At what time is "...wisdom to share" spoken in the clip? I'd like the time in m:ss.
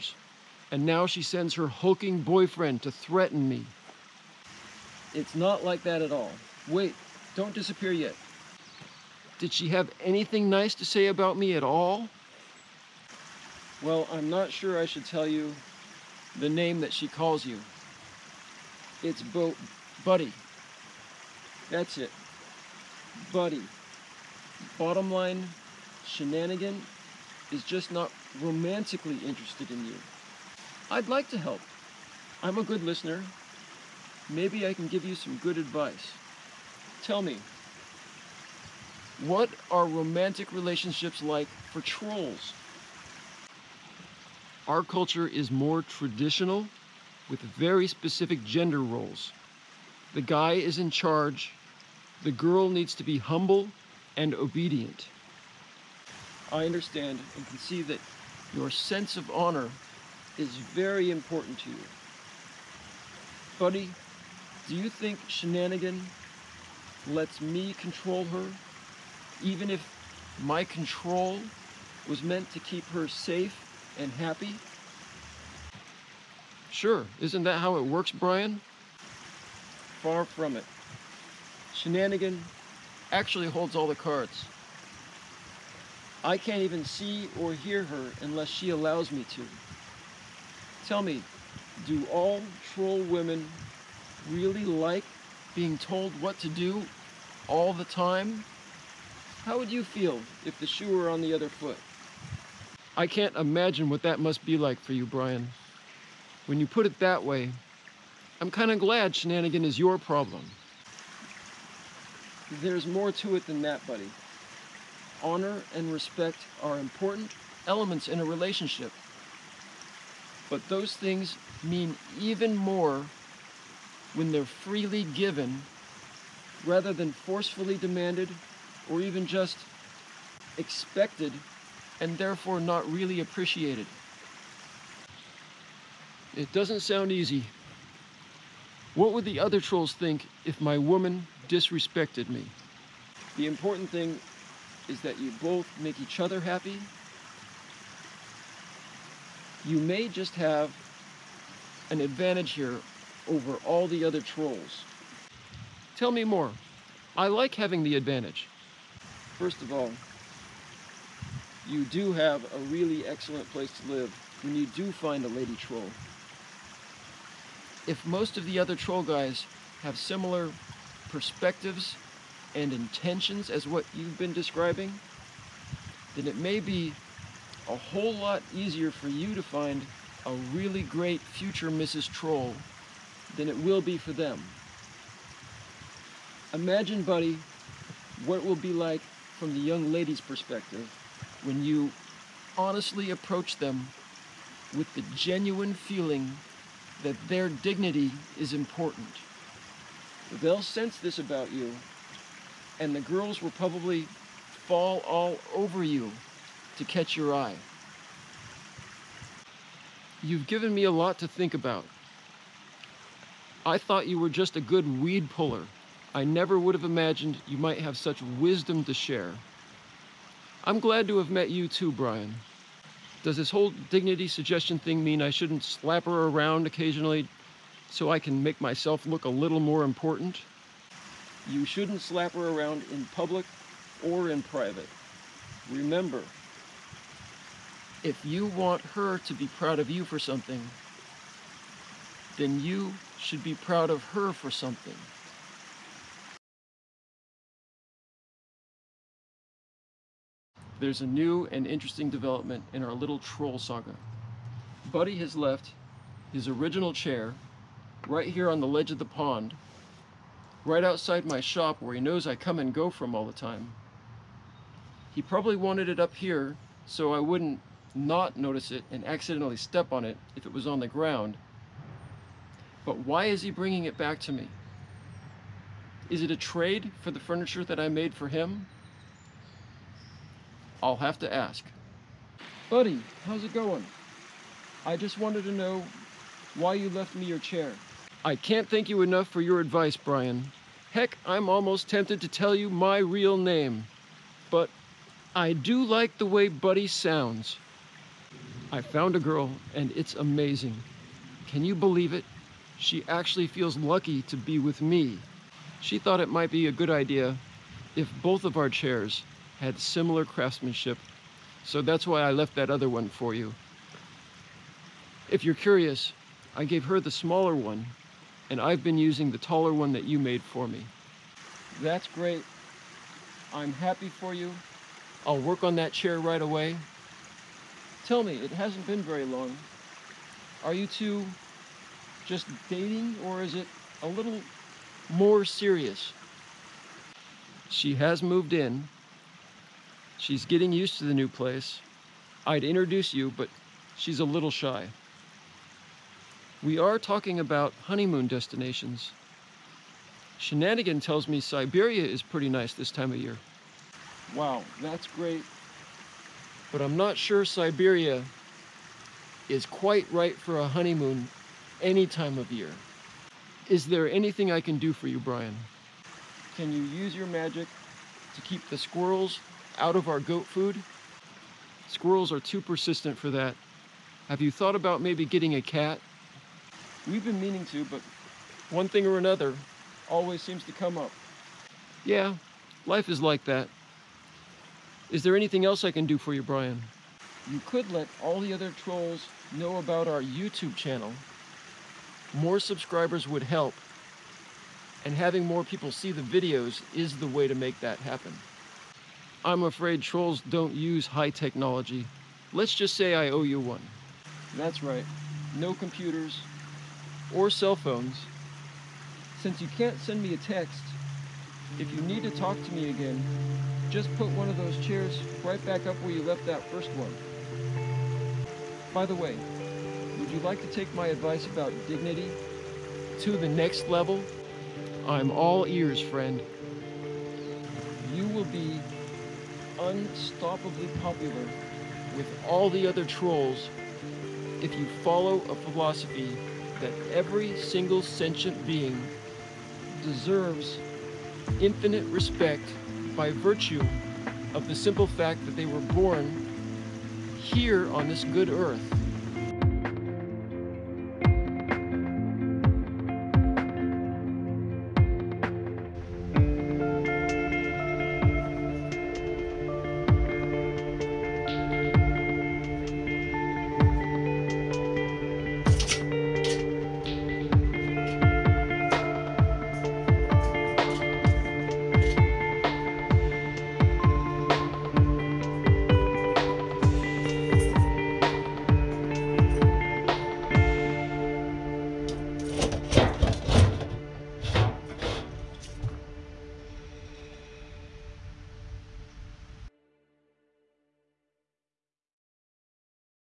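3:38.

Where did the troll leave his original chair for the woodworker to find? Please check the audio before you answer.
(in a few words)
On the ledge of the pond.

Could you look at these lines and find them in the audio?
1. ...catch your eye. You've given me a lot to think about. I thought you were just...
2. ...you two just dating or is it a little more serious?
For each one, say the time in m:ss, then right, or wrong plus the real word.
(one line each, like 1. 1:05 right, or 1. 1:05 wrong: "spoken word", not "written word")
1. 3:26 right
2. 5:30 right.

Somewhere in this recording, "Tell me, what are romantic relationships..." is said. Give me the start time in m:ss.
0:37.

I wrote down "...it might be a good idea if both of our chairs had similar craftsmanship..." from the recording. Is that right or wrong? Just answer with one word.
right.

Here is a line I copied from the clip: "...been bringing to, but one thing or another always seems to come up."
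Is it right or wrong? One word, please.
wrong.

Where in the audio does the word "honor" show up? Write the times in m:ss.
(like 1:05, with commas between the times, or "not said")
0:59, 1:55.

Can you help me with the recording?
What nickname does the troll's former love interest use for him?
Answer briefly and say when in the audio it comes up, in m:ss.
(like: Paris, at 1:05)
Bo Buddy, at 0:19.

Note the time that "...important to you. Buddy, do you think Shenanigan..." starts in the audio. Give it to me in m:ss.
1:01.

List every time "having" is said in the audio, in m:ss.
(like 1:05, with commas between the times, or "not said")
2:37, 6:35.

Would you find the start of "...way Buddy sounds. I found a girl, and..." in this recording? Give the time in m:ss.
4:56.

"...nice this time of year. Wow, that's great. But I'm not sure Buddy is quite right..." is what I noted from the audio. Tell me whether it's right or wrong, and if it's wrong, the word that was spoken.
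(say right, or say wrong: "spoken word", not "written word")
wrong: "Siberia", not "Buddy".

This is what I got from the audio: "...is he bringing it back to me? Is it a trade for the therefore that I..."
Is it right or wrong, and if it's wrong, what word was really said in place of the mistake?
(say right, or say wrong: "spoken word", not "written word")
wrong: "furniture", not "therefore".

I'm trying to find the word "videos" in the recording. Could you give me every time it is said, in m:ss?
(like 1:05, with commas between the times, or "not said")
6:36.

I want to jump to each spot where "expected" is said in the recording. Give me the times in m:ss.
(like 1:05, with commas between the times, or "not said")
2:10.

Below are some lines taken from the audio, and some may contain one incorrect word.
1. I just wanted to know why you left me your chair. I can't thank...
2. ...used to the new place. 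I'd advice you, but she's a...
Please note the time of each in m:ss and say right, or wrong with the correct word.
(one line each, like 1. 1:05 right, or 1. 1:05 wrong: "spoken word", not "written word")
1. 4:44 right
2. 5:40 wrong: "introduce", not "advice".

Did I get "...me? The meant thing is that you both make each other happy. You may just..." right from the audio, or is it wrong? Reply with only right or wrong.
wrong.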